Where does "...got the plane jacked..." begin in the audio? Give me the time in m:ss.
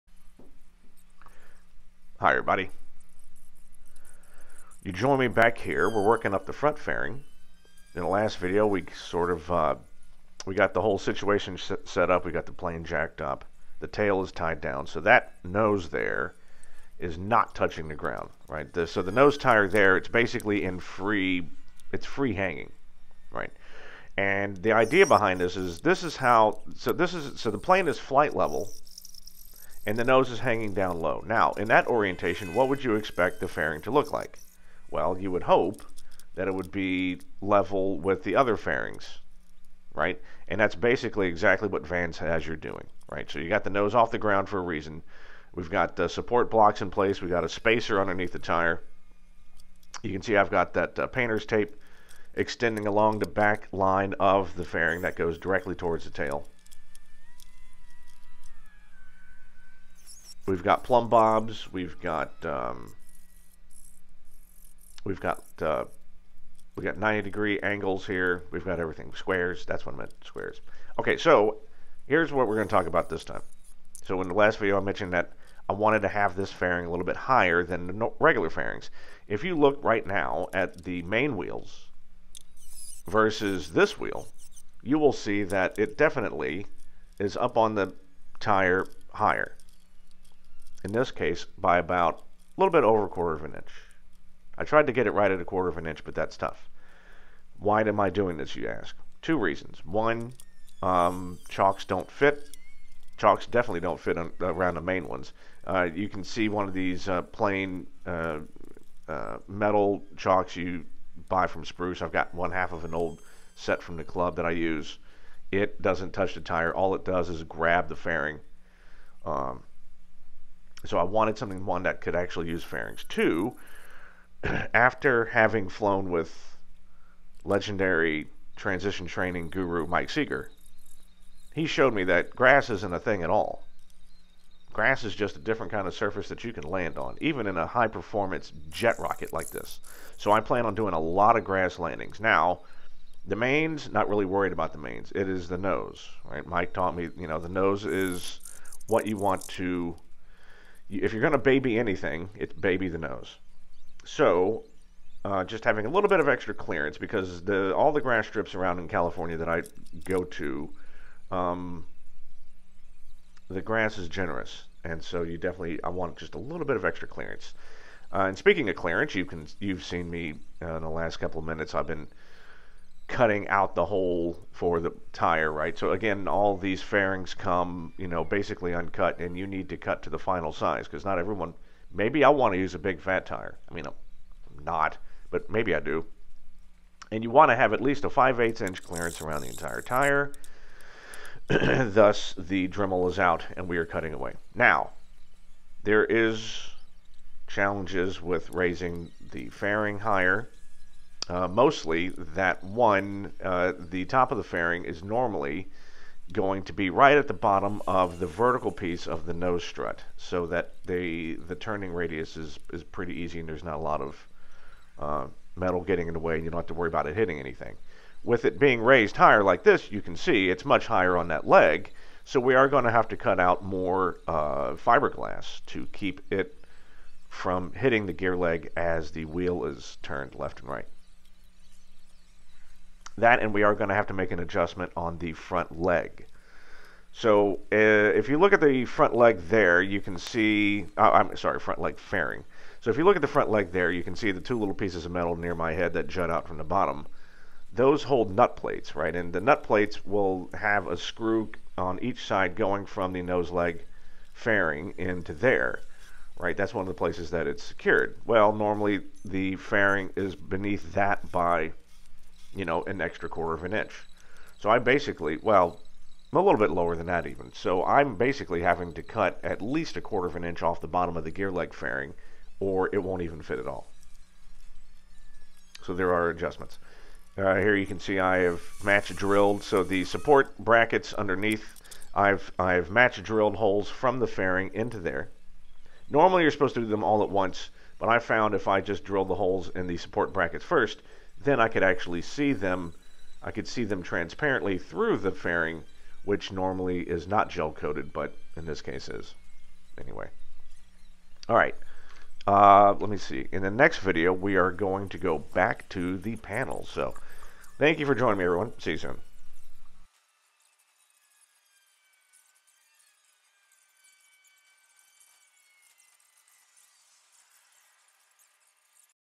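0:12.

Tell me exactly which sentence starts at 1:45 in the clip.
Uh, you can see one of these uh, plain uh, uh metal chalks you buy from Spruce.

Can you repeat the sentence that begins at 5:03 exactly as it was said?
In the next video, we are going to go back to the panel.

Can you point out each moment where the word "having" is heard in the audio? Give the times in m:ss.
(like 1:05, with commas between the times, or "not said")
2:05, 2:35, 4:28.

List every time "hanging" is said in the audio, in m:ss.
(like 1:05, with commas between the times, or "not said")
0:22, 0:30.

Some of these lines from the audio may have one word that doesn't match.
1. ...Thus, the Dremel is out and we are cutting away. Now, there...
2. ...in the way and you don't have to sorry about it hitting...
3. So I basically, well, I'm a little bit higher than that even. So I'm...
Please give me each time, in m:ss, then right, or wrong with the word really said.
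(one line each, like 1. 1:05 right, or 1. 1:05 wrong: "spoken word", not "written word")
1. 3:11 right
2. 3:36 wrong: "worry", not "sorry"
3. 4:24 wrong: "lower", not "higher".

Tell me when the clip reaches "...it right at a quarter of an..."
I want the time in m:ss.
1:35.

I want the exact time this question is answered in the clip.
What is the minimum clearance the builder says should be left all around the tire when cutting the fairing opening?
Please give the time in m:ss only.
3:08.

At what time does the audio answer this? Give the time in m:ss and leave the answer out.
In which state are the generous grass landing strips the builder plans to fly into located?
2:38.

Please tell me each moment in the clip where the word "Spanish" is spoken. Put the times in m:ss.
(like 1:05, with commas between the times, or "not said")
not said.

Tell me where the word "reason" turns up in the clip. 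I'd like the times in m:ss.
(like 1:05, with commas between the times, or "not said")
0:44, 1:39.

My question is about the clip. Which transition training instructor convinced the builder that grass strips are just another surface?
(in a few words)
Mike Seeger.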